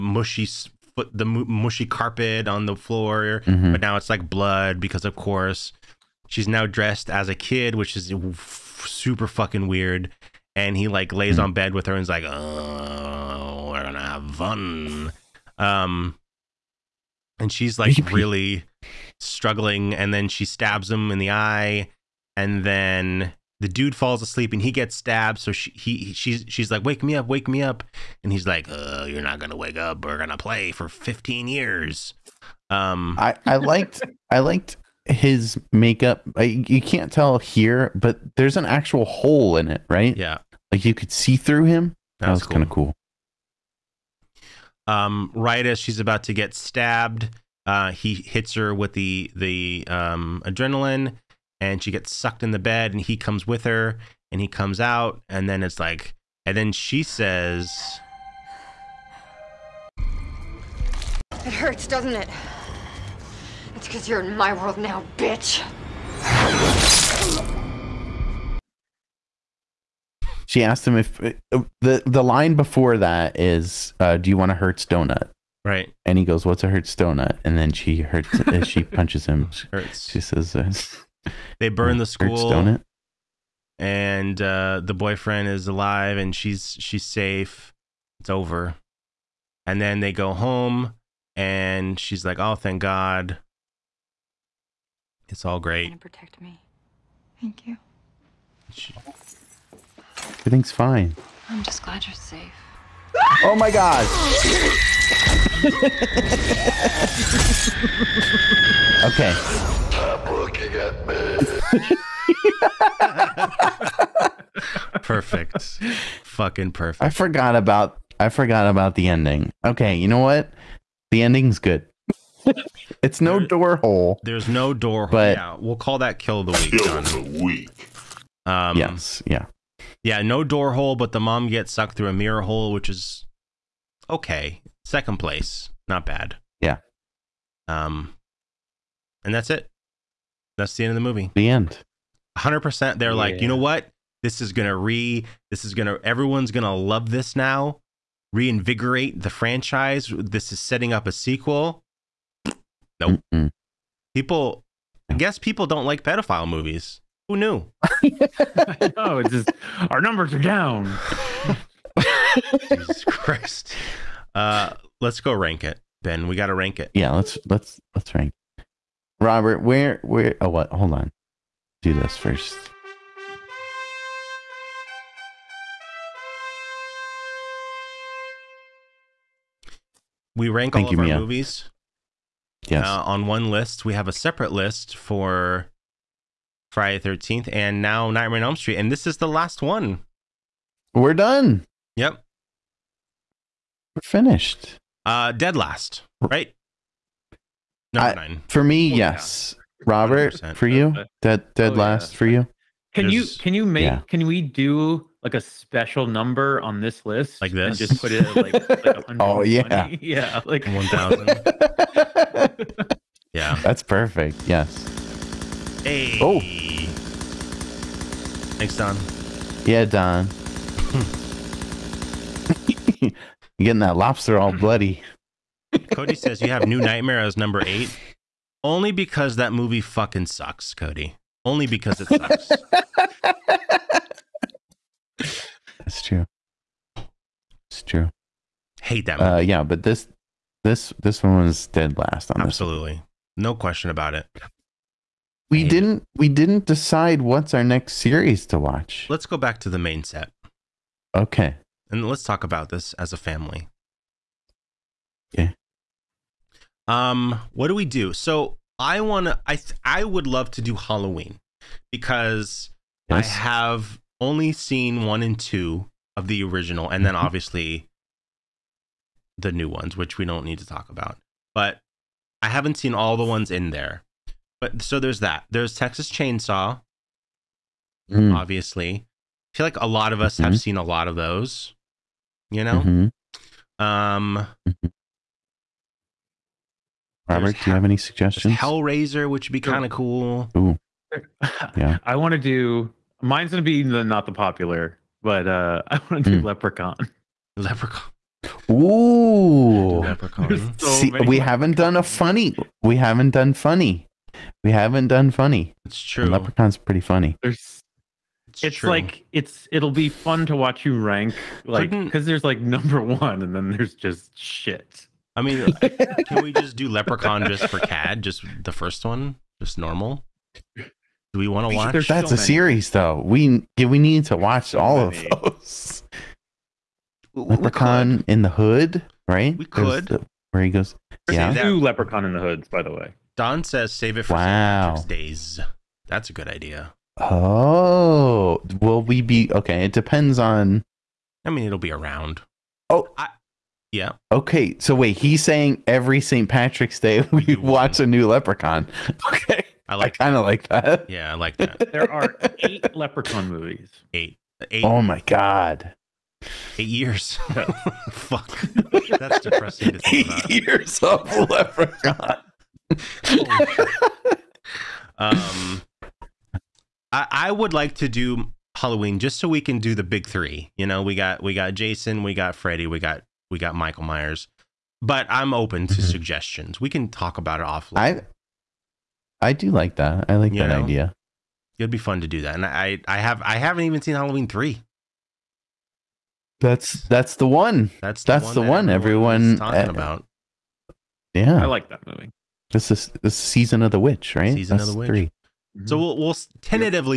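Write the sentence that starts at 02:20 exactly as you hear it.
That's the end of the movie.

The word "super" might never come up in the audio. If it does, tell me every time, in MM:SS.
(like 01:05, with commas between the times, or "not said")
00:08.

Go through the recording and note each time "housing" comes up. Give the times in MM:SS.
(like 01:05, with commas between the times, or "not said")
not said.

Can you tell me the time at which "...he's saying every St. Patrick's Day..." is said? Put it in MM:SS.
05:45.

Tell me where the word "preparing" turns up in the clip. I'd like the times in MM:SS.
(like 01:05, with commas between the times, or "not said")
not said.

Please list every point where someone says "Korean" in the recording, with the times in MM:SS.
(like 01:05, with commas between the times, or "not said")
not said.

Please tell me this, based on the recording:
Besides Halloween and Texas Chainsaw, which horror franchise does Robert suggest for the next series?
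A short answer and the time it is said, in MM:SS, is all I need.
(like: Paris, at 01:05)
Hellraiser, at 04:48.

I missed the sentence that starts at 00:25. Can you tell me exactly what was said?
So she, he, she's, she's like, wake me up, wake me up.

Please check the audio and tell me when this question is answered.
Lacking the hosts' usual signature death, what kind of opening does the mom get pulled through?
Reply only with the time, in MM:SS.
02:12.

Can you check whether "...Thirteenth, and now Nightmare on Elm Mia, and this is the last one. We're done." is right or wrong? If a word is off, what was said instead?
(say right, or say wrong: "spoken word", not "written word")
wrong: "Street", not "Mia".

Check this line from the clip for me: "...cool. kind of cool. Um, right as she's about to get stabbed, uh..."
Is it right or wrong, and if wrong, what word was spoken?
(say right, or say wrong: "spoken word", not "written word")
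right.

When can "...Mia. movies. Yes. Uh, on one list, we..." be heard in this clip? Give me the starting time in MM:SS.
03:01.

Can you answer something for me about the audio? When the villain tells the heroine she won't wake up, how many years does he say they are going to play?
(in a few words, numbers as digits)
15.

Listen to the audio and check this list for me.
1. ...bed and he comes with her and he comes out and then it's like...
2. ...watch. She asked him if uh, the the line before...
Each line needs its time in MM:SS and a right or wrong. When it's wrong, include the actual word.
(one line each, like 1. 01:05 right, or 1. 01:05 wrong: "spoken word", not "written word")
1. 00:52 right
2. 01:05 wrong: "bitch", not "watch".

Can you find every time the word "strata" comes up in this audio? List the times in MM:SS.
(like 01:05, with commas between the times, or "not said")
not said.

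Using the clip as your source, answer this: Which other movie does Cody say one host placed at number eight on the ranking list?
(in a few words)
New Nightmare.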